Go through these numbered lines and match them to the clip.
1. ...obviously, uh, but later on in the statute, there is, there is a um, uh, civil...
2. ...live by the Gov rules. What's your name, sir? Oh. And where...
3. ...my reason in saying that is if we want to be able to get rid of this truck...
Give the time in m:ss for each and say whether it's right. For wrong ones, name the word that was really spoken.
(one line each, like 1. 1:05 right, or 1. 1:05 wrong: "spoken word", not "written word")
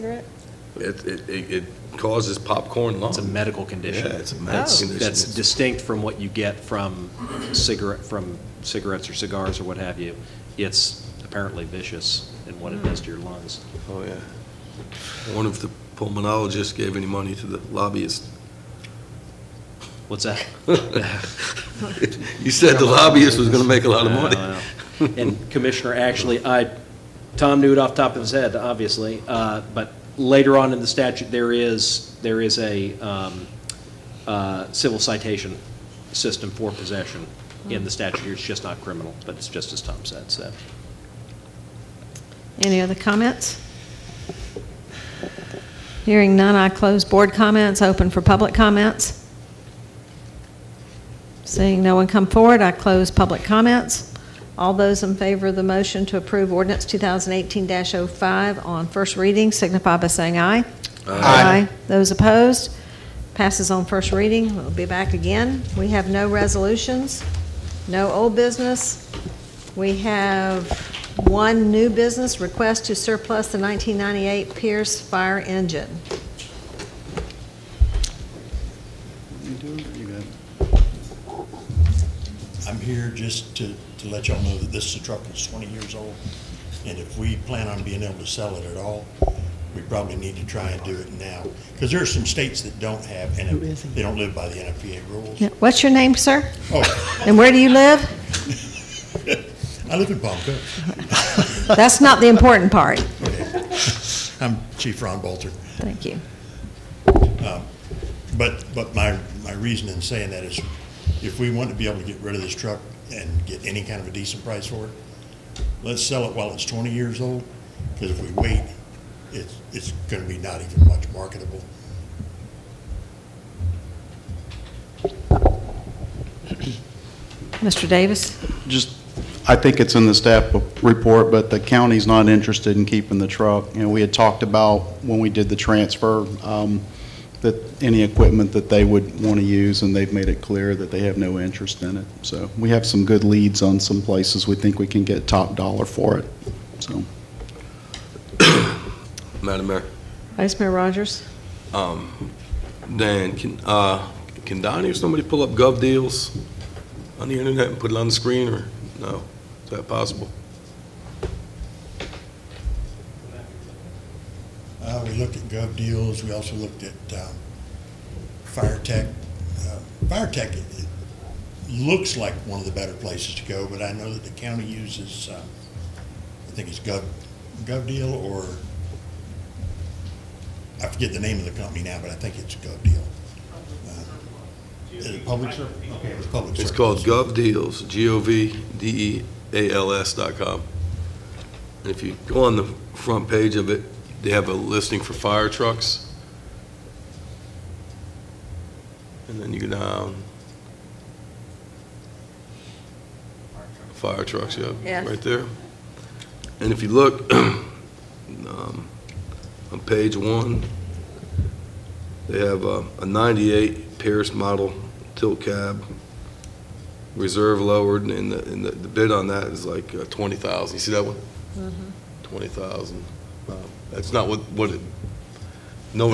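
1. 0:28 right
2. 1:34 wrong: "NFPA", not "Gov"
3. 1:49 right.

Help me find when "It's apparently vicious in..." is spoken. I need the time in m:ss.
0:10.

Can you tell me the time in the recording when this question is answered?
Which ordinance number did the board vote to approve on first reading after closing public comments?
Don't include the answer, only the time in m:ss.
0:56.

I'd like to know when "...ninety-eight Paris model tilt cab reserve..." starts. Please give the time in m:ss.
3:33.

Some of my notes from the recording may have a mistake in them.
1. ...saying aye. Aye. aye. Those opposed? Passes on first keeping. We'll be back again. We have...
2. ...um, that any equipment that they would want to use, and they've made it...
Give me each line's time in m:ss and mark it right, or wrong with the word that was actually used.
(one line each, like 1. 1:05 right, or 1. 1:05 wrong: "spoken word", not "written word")
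1. 1:00 wrong: "reading", not "keeping"
2. 2:16 right.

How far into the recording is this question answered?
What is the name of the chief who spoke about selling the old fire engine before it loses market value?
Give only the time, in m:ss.
1:45.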